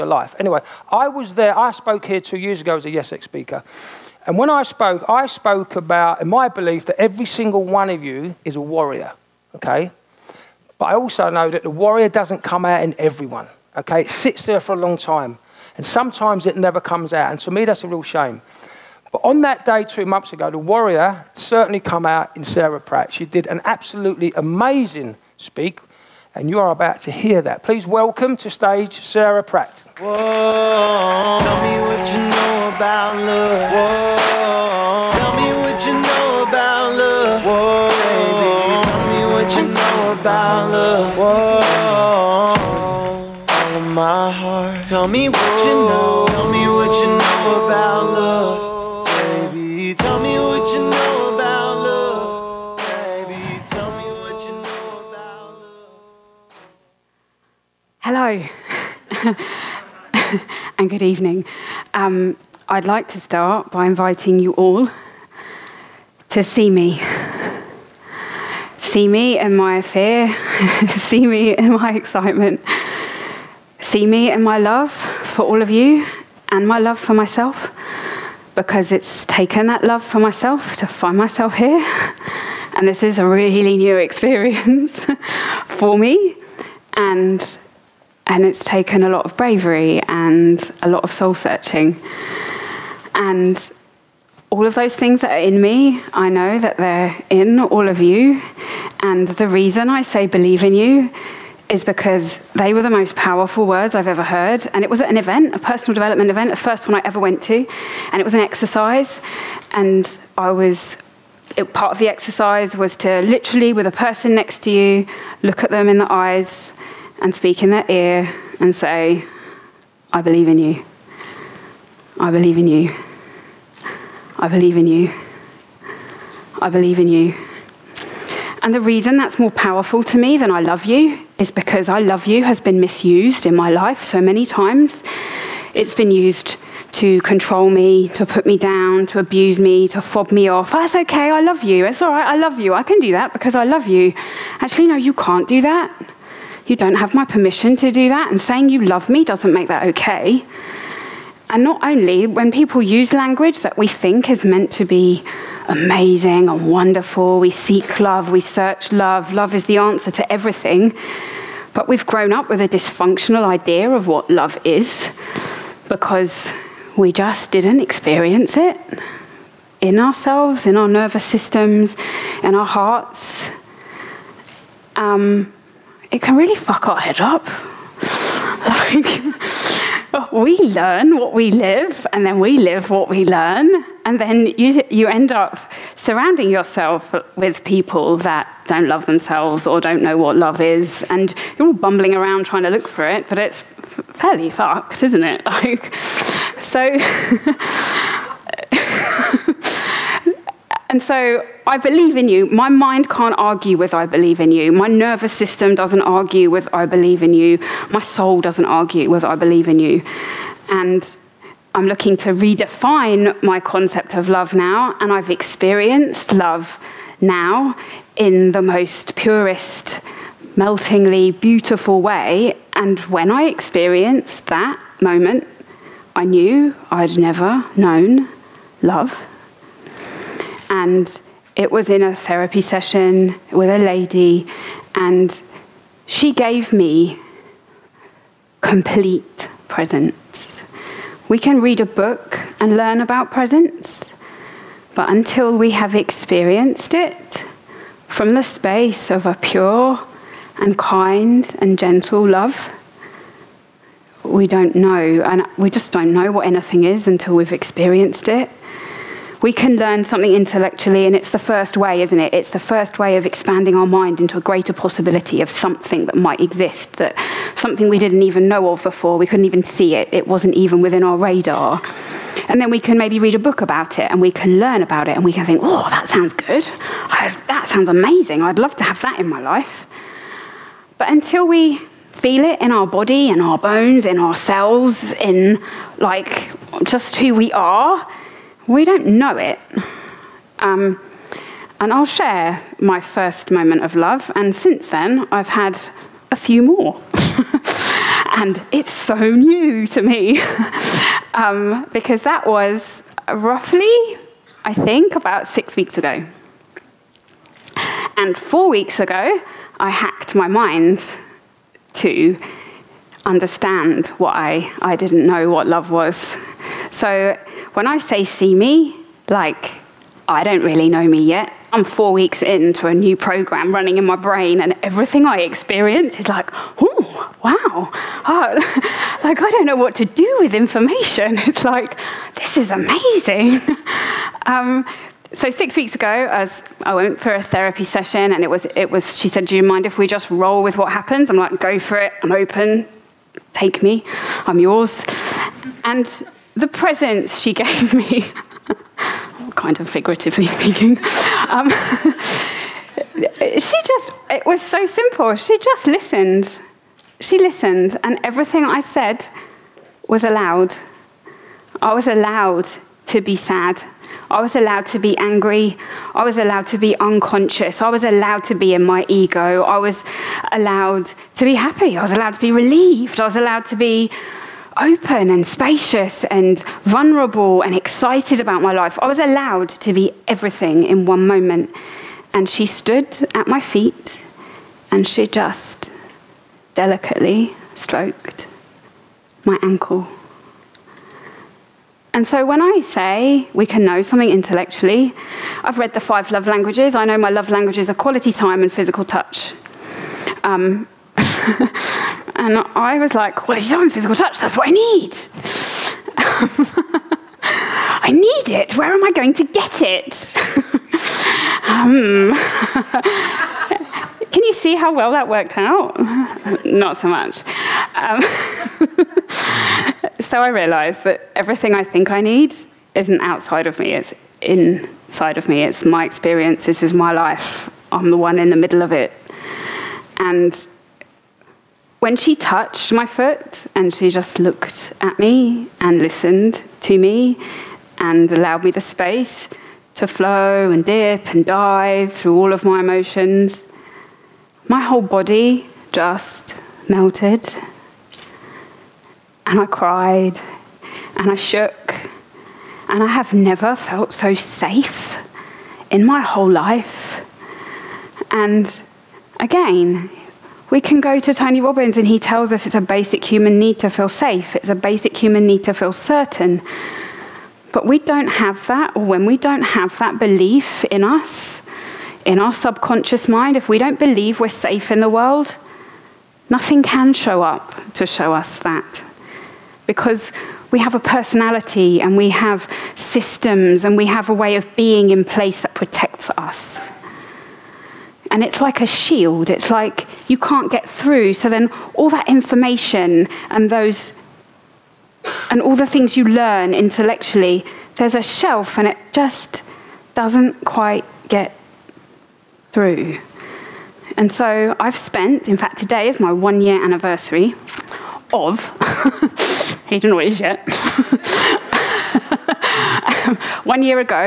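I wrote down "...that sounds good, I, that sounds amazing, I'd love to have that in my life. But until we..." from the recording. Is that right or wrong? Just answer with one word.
right.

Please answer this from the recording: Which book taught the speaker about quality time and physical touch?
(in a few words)
The Five Love Languages.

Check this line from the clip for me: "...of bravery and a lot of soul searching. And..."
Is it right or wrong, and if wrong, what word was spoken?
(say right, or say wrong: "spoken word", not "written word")
right.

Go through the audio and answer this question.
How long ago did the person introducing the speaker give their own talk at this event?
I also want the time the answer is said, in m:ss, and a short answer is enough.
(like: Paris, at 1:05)
2 years, at 0:02.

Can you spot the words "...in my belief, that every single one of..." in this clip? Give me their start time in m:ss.
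0:06.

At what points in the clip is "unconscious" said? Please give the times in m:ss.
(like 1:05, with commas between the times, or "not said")
6:06.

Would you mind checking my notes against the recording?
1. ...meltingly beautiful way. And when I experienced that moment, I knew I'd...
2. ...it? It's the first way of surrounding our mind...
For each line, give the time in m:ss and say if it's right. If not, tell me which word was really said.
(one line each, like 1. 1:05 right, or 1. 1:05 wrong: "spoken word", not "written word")
1. 3:40 right
2. 4:22 wrong: "expanding", not "surrounding".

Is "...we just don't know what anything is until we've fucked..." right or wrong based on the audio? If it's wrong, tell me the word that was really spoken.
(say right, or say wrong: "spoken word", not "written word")
wrong: "experienced", not "fucked".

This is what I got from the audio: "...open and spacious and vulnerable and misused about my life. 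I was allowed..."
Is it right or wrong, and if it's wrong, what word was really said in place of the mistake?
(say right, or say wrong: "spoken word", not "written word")
wrong: "excited", not "misused".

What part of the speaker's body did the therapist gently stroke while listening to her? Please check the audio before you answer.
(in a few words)
ankle.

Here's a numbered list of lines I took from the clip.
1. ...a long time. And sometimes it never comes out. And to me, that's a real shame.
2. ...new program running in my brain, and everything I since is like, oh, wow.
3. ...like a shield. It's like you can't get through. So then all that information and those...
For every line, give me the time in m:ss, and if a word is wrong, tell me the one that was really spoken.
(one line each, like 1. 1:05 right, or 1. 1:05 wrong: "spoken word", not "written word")
1. 0:14 right
2. 5:22 wrong: "experience", not "since"
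3. 8:08 right.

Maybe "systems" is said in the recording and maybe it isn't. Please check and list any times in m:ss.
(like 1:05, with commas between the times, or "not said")
2:51, 3:25, 8:02.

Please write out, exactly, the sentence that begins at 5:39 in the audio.
She said, "Do you mind if we just roll with what happens?" I'm like, "Go for it.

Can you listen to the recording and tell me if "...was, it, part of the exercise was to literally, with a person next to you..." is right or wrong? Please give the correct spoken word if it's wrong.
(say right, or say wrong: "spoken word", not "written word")
right.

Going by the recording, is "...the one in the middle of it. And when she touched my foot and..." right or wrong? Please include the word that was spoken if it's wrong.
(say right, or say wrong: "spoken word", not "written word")
right.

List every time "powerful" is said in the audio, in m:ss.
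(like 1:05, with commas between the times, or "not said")
1:43, 2:09.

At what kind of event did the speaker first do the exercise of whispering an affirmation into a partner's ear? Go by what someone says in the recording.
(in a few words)
personal development event.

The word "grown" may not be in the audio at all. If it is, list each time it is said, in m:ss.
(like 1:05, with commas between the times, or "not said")
2:42.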